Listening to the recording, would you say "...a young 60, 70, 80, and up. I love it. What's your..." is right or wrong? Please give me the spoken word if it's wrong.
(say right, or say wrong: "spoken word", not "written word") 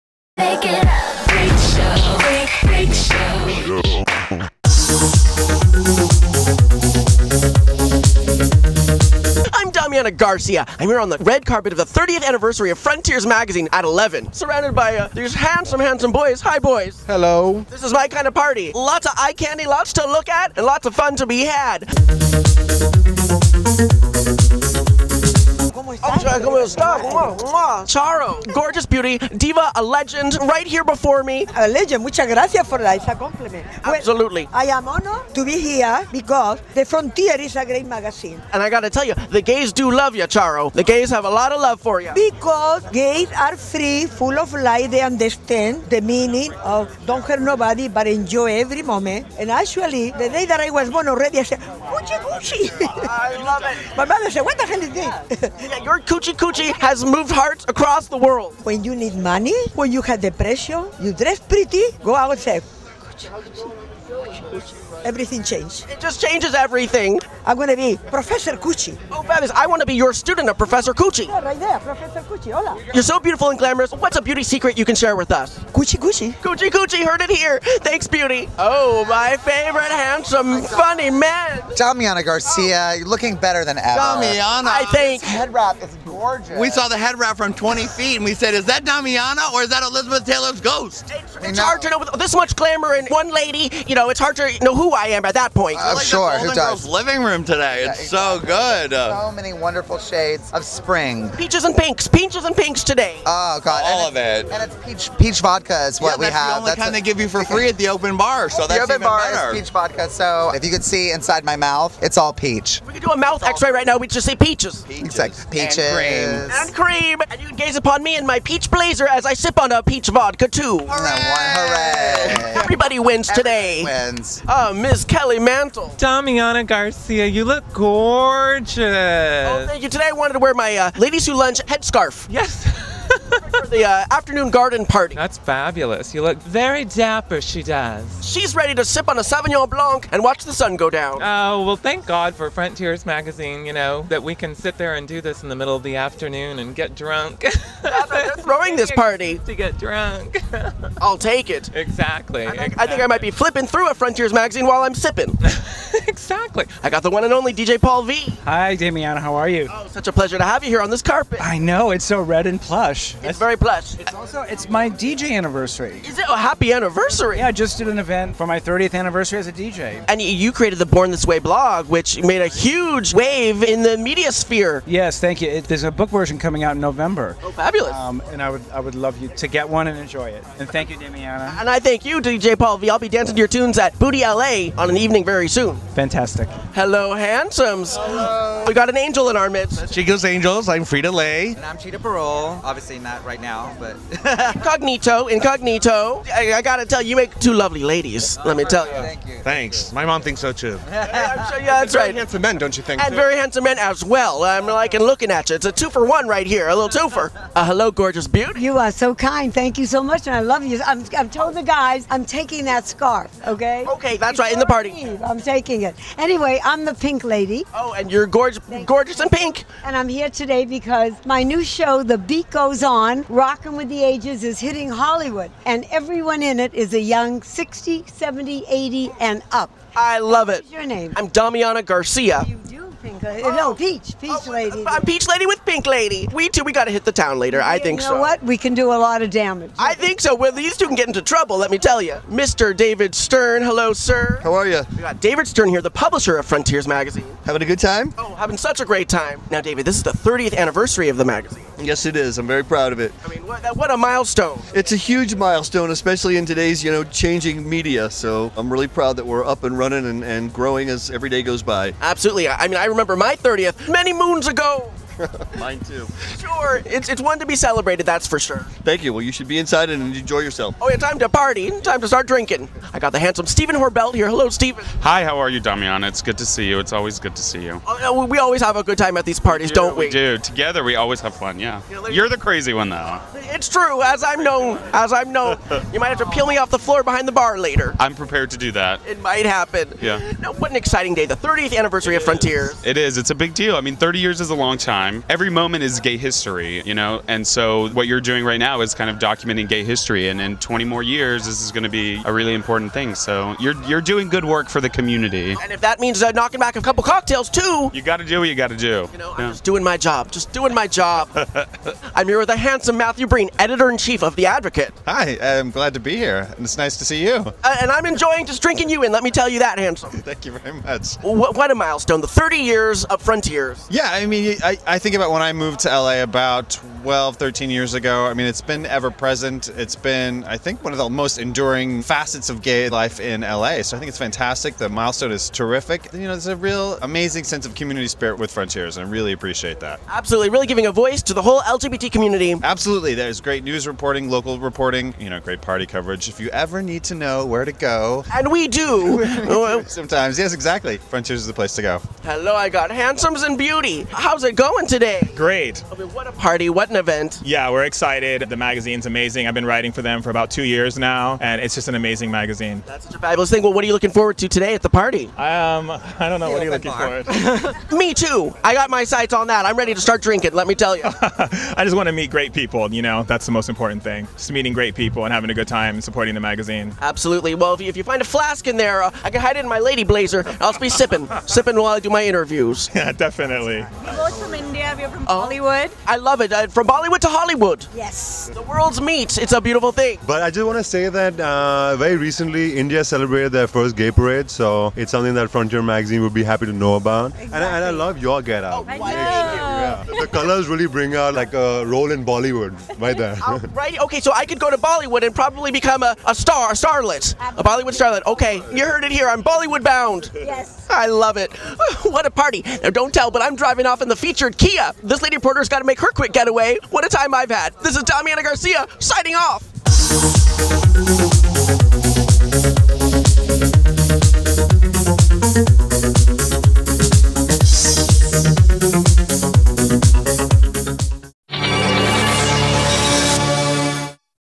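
right.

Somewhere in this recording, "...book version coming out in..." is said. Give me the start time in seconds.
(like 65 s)
175 s.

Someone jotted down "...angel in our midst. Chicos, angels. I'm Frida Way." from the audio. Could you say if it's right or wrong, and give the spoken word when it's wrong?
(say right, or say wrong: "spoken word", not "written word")
wrong: "Lay", not "Way".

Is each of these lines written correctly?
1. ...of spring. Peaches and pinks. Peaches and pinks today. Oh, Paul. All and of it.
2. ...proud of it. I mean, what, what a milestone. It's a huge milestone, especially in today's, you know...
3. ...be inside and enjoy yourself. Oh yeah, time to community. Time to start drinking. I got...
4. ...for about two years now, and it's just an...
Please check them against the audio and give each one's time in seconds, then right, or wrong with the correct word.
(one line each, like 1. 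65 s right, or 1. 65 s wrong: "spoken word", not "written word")
1. 100 s wrong: "God", not "Paul"
2. 252 s right
3. 269 s wrong: "party", not "community"
4. 360 s right.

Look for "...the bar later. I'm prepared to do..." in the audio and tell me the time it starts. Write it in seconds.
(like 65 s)
287 s.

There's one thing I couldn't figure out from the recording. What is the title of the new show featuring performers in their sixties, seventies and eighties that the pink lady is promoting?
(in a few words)
The Beat Goes On.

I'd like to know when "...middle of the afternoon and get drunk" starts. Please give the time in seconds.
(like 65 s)
145 s.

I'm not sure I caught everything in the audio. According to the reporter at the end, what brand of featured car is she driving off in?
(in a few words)
Kia.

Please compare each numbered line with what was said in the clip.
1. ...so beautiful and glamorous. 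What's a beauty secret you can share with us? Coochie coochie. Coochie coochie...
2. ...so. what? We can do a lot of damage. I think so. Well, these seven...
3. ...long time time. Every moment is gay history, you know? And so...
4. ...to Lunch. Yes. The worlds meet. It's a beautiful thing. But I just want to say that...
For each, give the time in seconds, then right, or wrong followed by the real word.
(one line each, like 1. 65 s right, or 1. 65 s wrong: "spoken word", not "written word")
1. 73 s right
2. 238 s wrong: "two", not "seven"
3. 294 s right
4. 387 s wrong: "Hollywood", not "Lunch".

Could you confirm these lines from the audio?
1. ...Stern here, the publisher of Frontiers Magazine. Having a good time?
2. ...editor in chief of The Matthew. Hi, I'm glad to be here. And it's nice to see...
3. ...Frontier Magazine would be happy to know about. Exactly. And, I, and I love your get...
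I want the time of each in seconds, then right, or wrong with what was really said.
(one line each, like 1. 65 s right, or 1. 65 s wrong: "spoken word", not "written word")
1. 245 s right
2. 313 s wrong: "Advocate", not "Matthew"
3. 395 s right.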